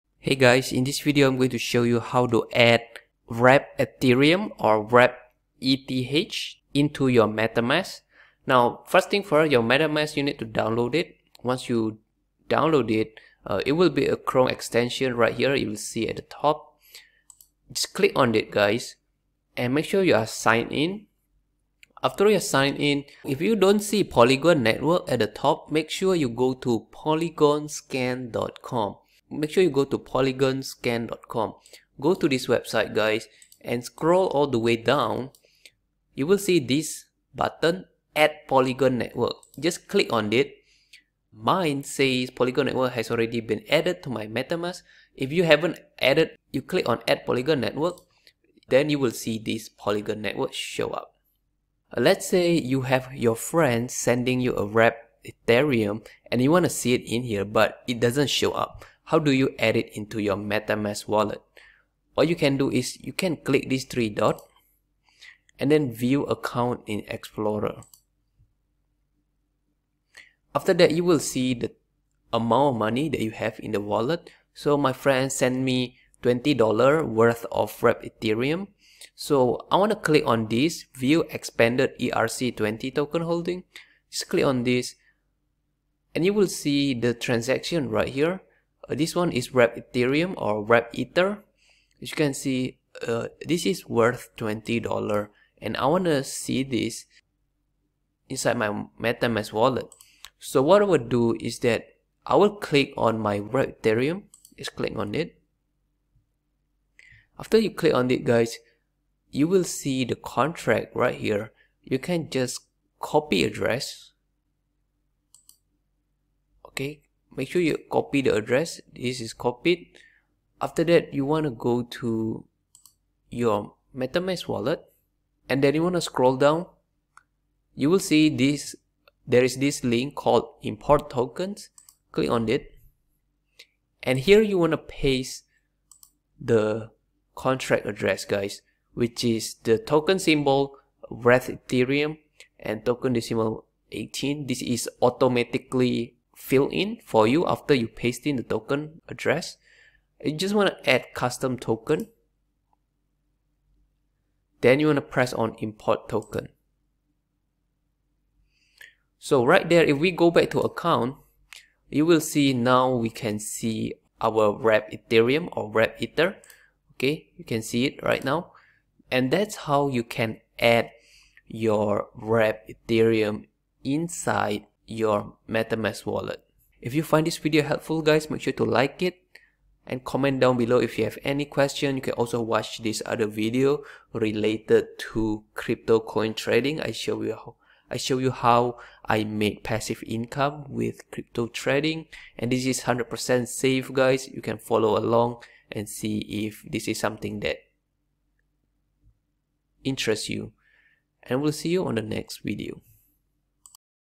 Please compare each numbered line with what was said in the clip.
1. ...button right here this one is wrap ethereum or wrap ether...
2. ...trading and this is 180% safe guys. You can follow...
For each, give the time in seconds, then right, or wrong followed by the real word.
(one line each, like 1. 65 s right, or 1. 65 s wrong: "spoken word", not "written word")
1. 87 s wrong: "transaction", not "button"
2. 191 s wrong: "100", not "180".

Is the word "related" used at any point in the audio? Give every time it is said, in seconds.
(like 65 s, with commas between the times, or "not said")
184 s.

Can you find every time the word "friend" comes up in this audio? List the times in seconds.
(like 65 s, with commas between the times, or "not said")
53 s, 74 s.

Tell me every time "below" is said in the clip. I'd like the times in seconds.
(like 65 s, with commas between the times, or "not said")
180 s.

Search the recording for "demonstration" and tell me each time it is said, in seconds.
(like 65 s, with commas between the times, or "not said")
not said.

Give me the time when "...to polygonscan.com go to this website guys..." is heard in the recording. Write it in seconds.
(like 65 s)
29 s.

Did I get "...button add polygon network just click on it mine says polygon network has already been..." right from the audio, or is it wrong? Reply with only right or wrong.
right.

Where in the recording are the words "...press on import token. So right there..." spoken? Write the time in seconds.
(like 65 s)
155 s.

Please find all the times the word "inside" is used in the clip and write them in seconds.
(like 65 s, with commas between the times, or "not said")
98 s, 173 s.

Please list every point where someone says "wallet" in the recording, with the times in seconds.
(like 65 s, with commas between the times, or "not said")
61 s, 73 s, 99 s, 124 s, 176 s.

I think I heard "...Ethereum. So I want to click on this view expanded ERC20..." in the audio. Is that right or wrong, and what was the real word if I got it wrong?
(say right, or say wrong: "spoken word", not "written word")
right.